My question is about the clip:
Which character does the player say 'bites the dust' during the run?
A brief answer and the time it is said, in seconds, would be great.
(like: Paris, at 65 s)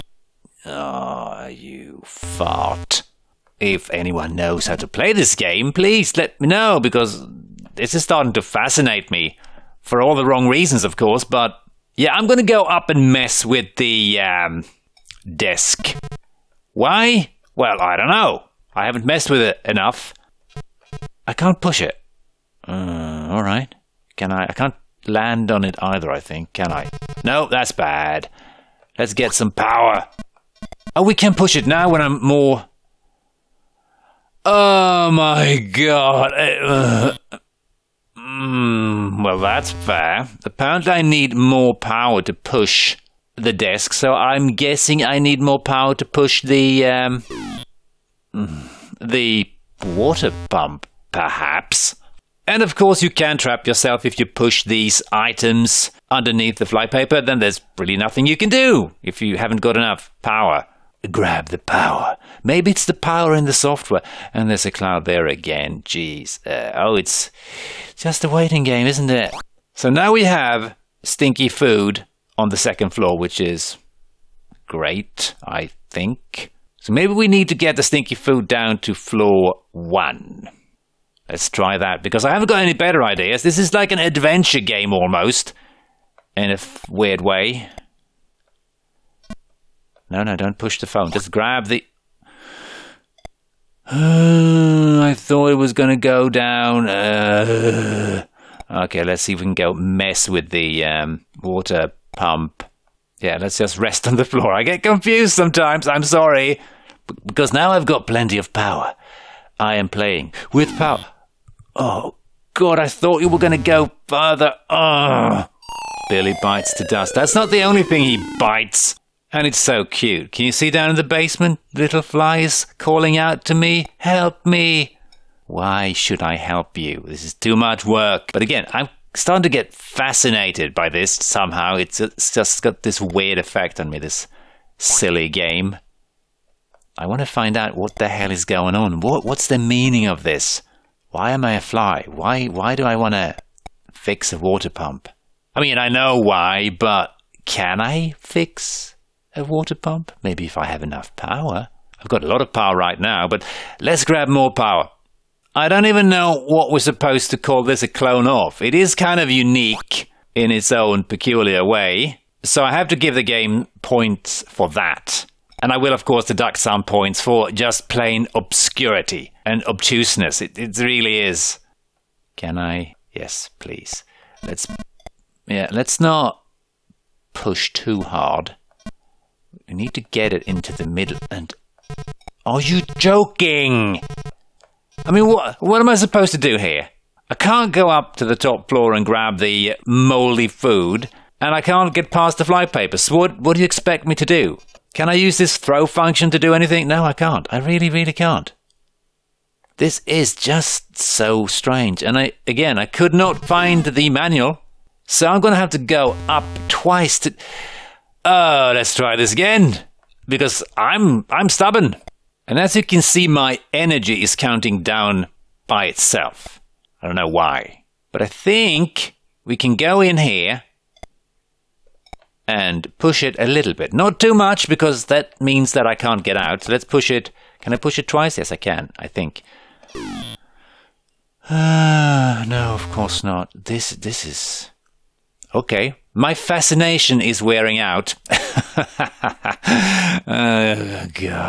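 Billy, at 116 s.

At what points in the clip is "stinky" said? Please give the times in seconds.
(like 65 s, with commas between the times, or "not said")
71 s, 77 s.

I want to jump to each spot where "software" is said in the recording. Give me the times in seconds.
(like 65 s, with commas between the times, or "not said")
63 s.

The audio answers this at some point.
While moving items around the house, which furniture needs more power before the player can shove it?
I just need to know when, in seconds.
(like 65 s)
42 s.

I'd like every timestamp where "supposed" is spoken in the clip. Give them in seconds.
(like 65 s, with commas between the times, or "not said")
156 s, 185 s.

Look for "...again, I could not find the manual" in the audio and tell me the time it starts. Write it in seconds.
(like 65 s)
202 s.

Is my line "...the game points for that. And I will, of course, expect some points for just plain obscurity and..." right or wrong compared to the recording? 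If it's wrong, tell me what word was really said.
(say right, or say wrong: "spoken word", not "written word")
wrong: "deduct", not "expect".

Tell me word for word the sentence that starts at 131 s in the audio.
It's, it's just got this weird effect on me, this silly game.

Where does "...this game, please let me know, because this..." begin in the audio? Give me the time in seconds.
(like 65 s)
5 s.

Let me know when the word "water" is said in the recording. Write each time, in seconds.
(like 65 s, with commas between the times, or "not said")
49 s, 101 s, 144 s, 149 s.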